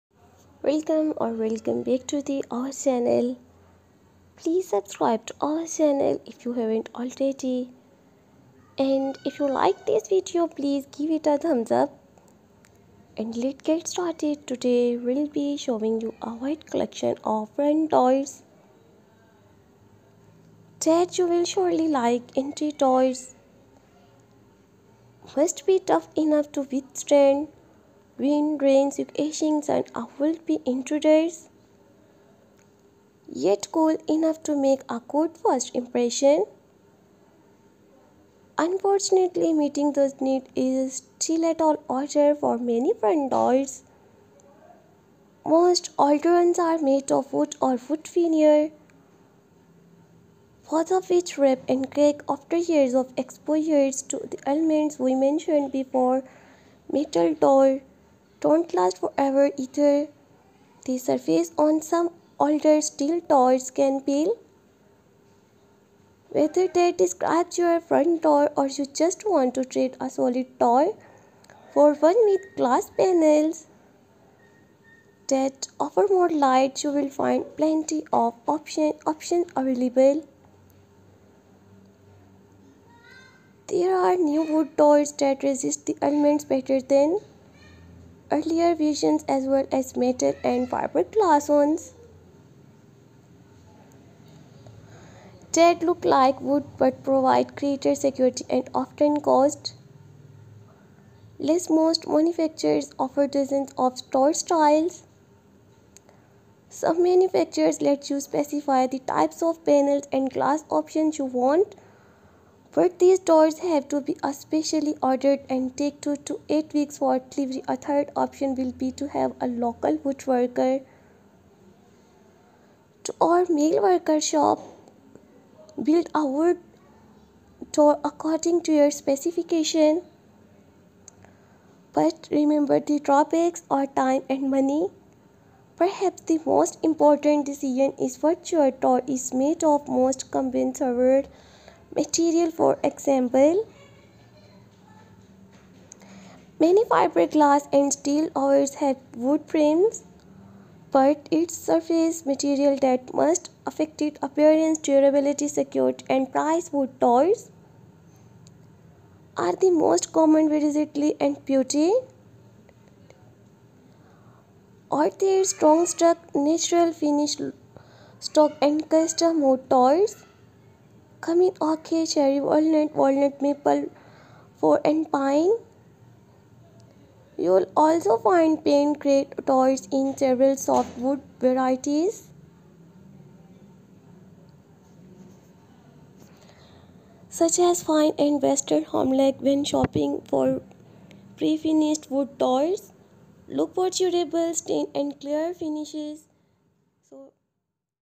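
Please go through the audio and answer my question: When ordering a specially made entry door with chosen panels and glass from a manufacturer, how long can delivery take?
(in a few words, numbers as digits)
2 to 8 weeks.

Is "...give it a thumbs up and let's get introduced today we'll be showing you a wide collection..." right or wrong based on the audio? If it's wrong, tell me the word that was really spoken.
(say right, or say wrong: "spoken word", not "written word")
wrong: "started", not "introduced".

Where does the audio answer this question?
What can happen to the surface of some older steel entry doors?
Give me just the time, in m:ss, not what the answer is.
1:04.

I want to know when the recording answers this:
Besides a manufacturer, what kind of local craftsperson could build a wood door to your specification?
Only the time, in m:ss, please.
2:00.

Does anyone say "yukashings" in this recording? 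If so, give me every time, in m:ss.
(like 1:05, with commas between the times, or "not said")
0:28.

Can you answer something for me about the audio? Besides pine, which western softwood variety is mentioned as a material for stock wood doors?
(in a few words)
western hemlock.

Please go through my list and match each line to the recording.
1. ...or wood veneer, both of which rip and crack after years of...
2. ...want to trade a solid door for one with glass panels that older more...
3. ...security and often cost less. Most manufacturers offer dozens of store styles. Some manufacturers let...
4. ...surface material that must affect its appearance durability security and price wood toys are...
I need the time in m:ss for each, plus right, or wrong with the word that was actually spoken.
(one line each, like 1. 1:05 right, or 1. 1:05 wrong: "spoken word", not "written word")
1. 0:47 right
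2. 1:09 wrong: "offer", not "older"
3. 1:38 right
4. 2:31 right.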